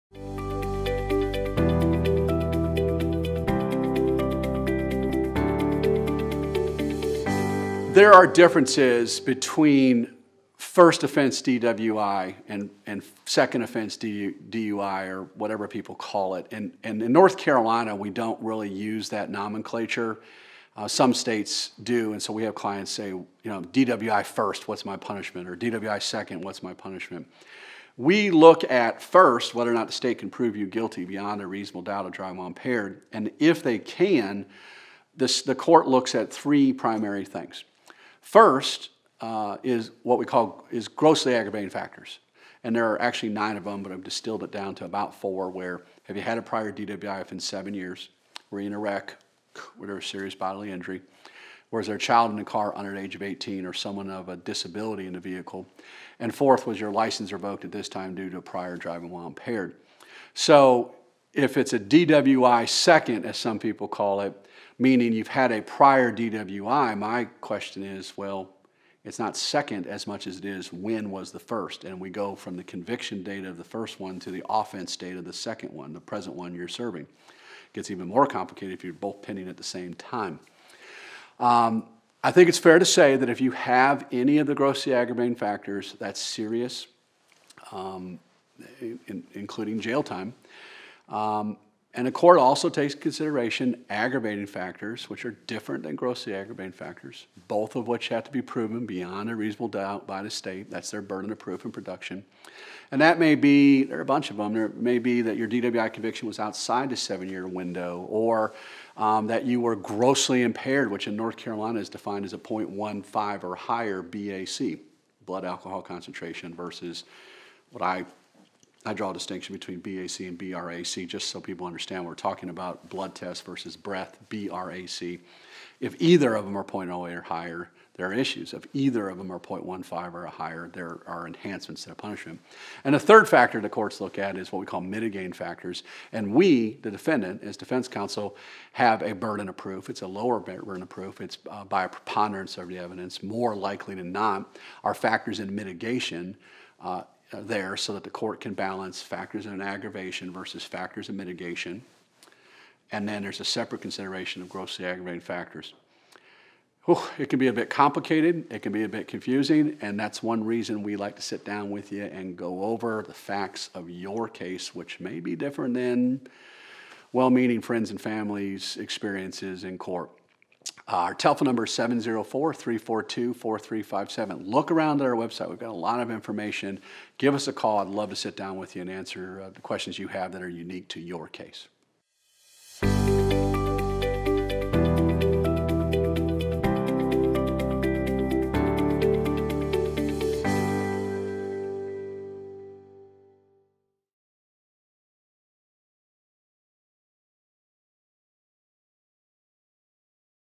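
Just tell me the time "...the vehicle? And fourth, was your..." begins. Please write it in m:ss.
0:55.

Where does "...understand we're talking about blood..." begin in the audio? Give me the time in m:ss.
2:01.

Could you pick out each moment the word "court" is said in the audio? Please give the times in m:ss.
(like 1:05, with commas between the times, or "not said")
0:35, 1:32, 2:13, 2:28, 2:49.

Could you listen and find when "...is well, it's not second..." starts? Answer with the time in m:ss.
1:07.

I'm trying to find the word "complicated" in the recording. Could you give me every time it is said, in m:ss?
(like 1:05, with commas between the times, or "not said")
1:18, 2:37.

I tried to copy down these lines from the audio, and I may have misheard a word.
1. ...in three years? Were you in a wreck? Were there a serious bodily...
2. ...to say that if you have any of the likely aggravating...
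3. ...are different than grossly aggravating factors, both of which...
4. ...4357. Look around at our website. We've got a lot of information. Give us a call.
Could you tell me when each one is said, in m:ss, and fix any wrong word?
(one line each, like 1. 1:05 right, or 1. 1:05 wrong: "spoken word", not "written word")
1. 0:47 wrong: "seven", not "three"
2. 1:22 wrong: "grossly", not "likely"
3. 1:35 right
4. 2:53 right.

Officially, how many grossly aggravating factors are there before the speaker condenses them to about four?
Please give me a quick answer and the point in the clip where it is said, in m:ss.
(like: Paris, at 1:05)
9, at 0:43.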